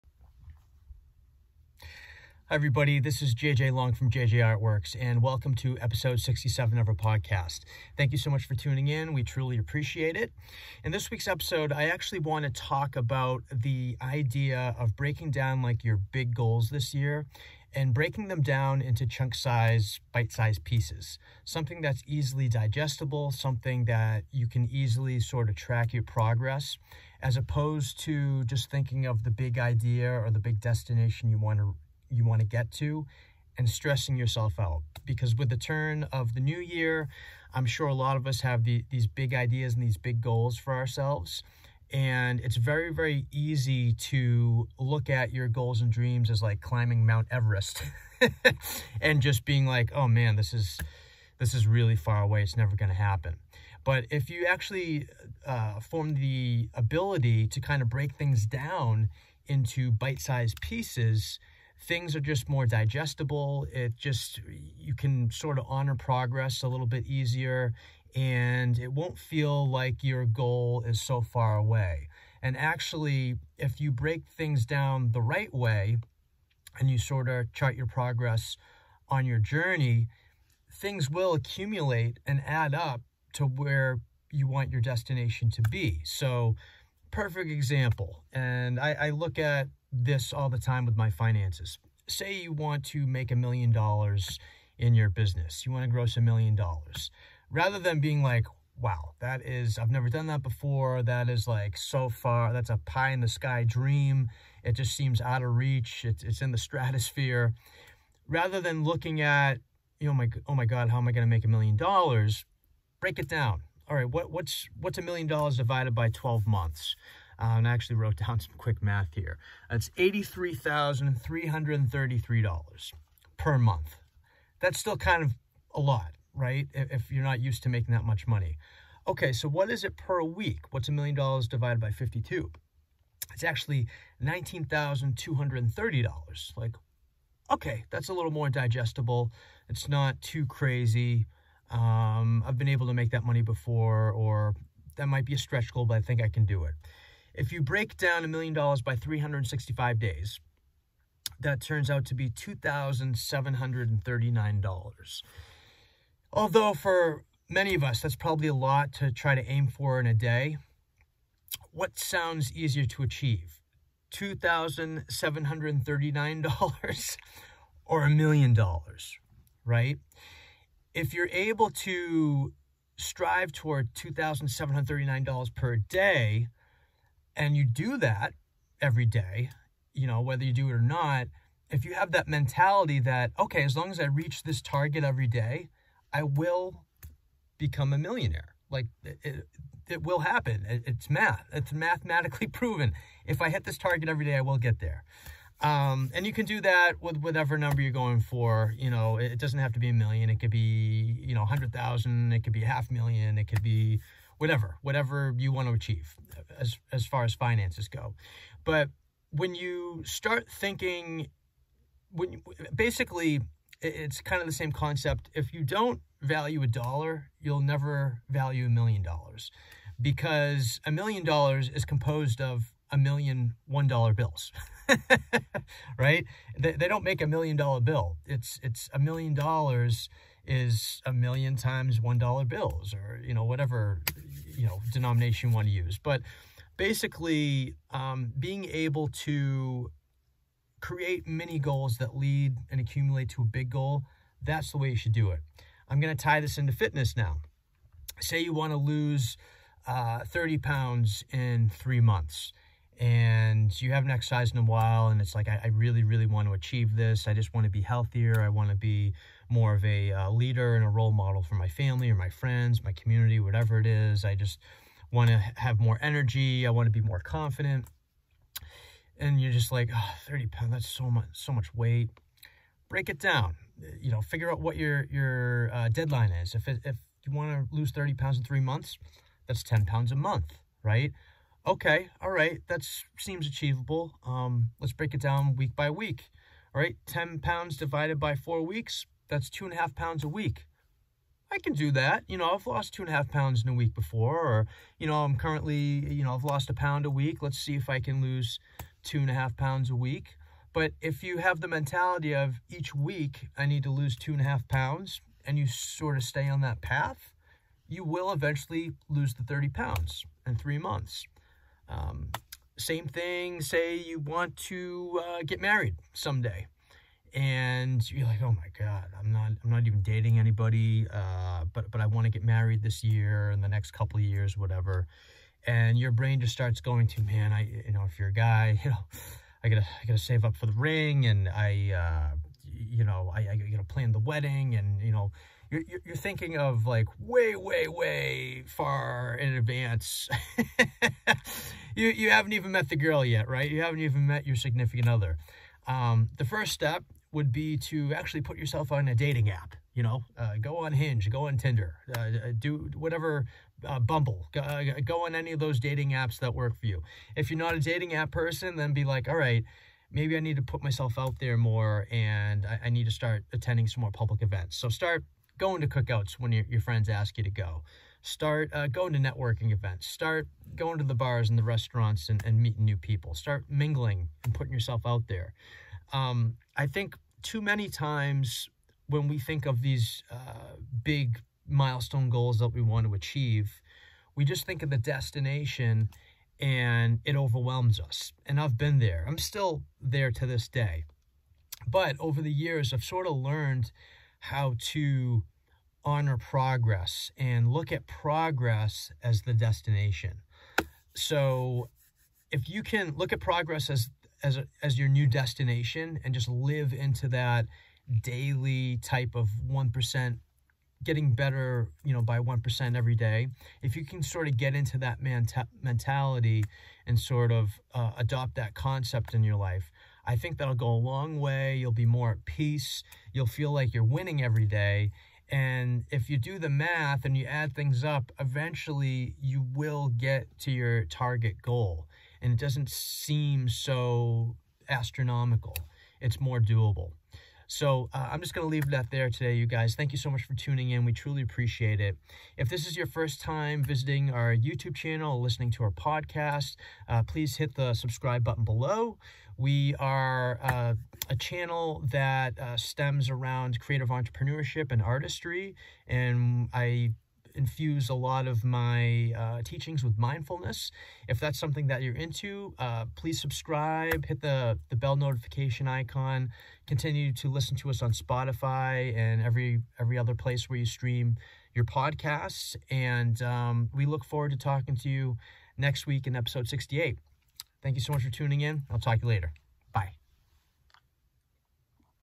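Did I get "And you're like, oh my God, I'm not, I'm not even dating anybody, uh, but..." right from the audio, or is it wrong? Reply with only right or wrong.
right.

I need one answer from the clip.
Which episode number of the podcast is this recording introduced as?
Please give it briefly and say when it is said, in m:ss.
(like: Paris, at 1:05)
67, at 0:05.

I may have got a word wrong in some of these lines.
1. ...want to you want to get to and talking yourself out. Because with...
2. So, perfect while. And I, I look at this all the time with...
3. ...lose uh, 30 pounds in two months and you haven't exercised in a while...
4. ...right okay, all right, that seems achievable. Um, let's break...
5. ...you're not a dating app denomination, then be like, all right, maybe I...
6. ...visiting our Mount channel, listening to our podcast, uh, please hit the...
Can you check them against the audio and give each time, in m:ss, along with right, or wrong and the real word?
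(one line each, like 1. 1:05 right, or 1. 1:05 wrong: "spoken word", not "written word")
1. 0:31 wrong: "stressing", not "talking"
2. 1:26 wrong: "example", not "while"
3. 4:08 wrong: "three", not "two"
4. 4:40 right
5. 5:57 wrong: "person", not "denomination"
6. 7:23 wrong: "YouTube", not "Mount".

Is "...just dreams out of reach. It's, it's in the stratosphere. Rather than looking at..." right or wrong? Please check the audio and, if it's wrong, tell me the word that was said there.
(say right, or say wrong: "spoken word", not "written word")
wrong: "seems", not "dreams".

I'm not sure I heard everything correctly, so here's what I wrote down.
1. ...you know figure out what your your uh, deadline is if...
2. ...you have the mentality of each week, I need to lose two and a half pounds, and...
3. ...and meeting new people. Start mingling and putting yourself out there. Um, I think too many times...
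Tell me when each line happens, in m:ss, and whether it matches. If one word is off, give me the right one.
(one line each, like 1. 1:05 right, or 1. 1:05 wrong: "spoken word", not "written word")
1. 4:33 right
2. 5:01 right
3. 6:12 right.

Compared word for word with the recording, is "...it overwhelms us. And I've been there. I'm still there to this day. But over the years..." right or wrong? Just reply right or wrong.
right.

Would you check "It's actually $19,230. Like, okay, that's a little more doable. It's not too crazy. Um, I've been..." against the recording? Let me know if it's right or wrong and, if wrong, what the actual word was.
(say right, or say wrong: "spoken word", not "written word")
wrong: "digestible", not "doable".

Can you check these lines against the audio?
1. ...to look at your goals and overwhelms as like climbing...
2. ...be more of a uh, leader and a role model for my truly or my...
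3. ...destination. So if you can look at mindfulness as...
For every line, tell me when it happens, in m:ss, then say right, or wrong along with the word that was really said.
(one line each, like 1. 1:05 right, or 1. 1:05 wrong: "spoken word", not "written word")
1. 0:43 wrong: "dreams", not "overwhelms"
2. 4:18 wrong: "family", not "truly"
3. 6:39 wrong: "progress", not "mindfulness".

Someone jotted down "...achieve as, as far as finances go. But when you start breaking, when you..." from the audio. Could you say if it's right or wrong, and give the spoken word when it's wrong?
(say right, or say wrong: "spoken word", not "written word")
wrong: "thinking", not "breaking".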